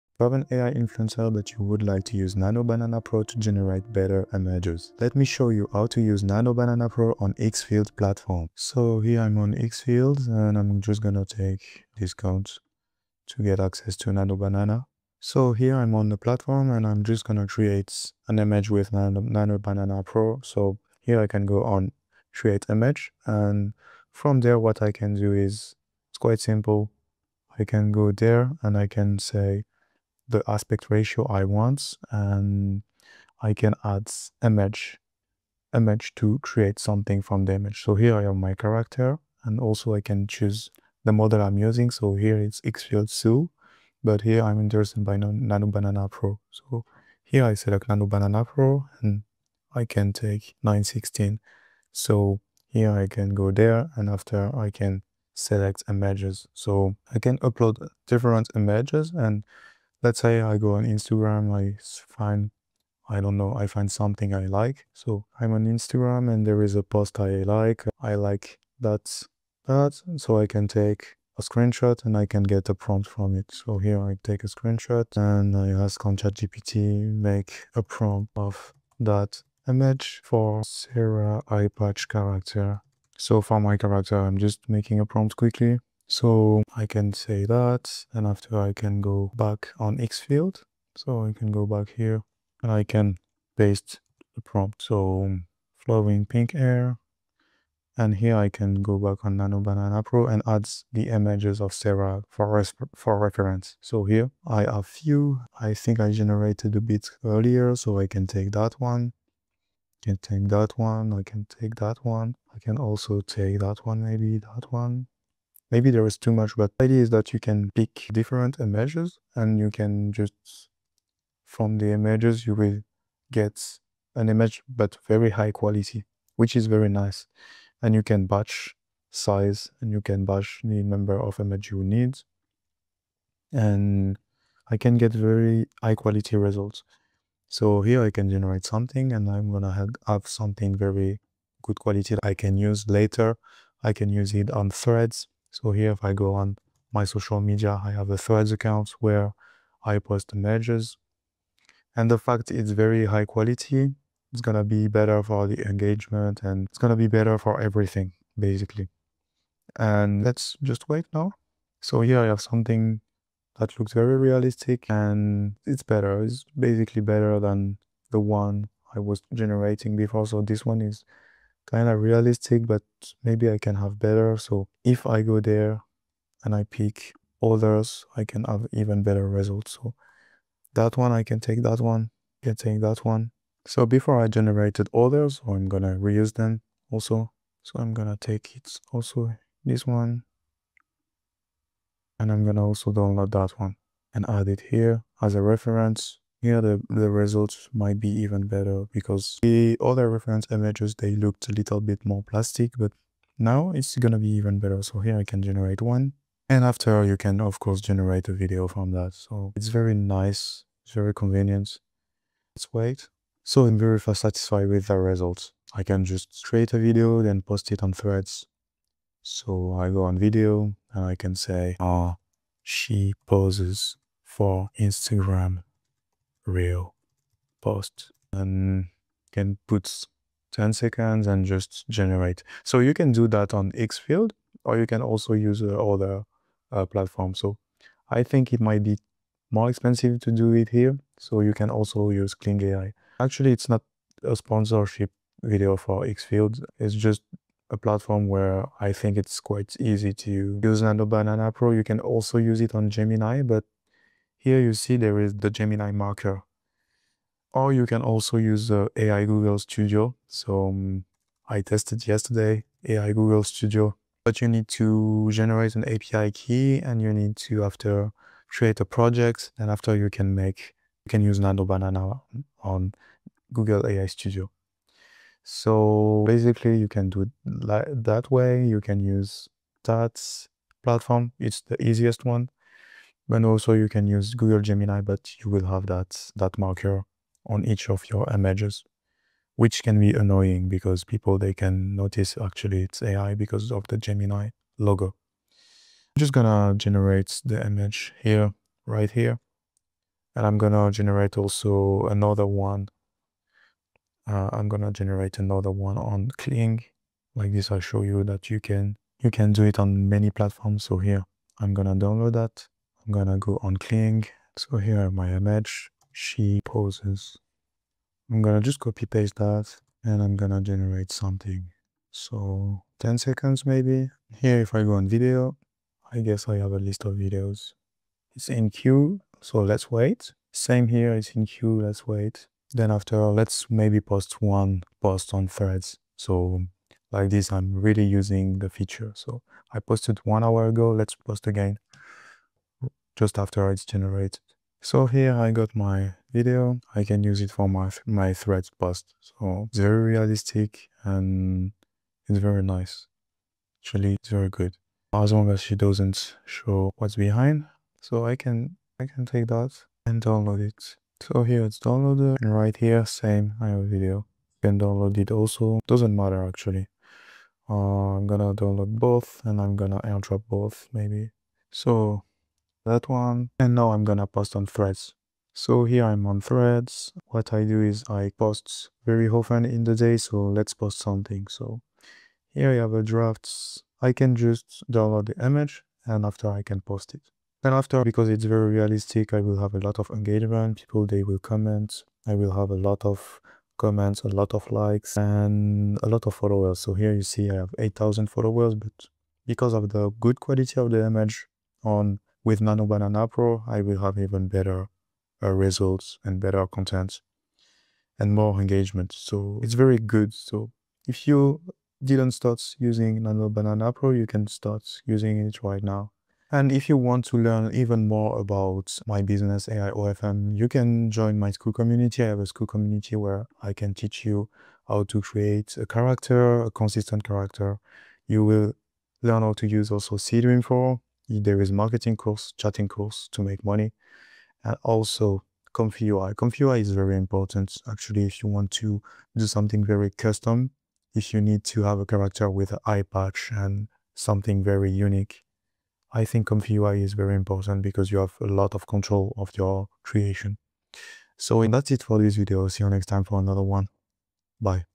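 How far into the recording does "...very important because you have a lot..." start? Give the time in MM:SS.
07:27.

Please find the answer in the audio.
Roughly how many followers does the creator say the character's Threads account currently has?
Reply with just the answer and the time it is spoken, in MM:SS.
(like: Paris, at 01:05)
8,000, at 06:37.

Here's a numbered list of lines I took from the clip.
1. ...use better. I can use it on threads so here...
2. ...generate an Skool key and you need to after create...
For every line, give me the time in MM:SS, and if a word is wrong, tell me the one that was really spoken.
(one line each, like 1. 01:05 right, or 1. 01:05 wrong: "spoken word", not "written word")
1. 02:22 wrong: "later", not "better"
2. 04:25 wrong: "API", not "Skool".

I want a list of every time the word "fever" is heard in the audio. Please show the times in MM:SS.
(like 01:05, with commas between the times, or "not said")
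not said.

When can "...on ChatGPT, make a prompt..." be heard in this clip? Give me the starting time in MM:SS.
01:16.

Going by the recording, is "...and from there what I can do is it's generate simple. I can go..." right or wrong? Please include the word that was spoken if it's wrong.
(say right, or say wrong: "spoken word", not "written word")
wrong: "quite", not "generate".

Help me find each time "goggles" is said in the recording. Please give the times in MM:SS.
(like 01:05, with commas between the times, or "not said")
not said.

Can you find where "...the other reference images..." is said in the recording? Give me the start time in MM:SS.
03:19.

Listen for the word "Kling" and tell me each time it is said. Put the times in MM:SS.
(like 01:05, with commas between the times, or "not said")
05:06, 05:13.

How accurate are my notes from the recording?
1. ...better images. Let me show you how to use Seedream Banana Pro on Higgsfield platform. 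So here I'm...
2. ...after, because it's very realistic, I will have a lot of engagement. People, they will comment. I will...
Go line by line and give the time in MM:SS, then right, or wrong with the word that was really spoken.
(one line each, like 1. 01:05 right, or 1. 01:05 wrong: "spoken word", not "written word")
1. 00:03 wrong: "Nano", not "Seedream"
2. 06:27 right.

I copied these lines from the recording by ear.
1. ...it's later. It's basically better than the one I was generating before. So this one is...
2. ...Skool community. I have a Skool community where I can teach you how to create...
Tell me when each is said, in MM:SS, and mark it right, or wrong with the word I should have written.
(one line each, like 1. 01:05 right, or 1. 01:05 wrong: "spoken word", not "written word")
1. 02:45 wrong: "better", not "later"
2. 07:01 right.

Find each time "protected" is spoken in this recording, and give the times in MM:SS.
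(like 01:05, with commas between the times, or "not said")
not said.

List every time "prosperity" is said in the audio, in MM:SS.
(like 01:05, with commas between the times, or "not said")
not said.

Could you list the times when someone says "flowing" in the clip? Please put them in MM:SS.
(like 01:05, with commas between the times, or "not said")
01:35.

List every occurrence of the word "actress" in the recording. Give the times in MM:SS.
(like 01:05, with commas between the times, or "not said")
not said.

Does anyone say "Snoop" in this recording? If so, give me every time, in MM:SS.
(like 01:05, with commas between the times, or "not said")
not said.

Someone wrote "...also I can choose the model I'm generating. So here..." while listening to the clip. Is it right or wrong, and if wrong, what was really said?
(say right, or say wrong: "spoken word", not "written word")
wrong: "using", not "generating".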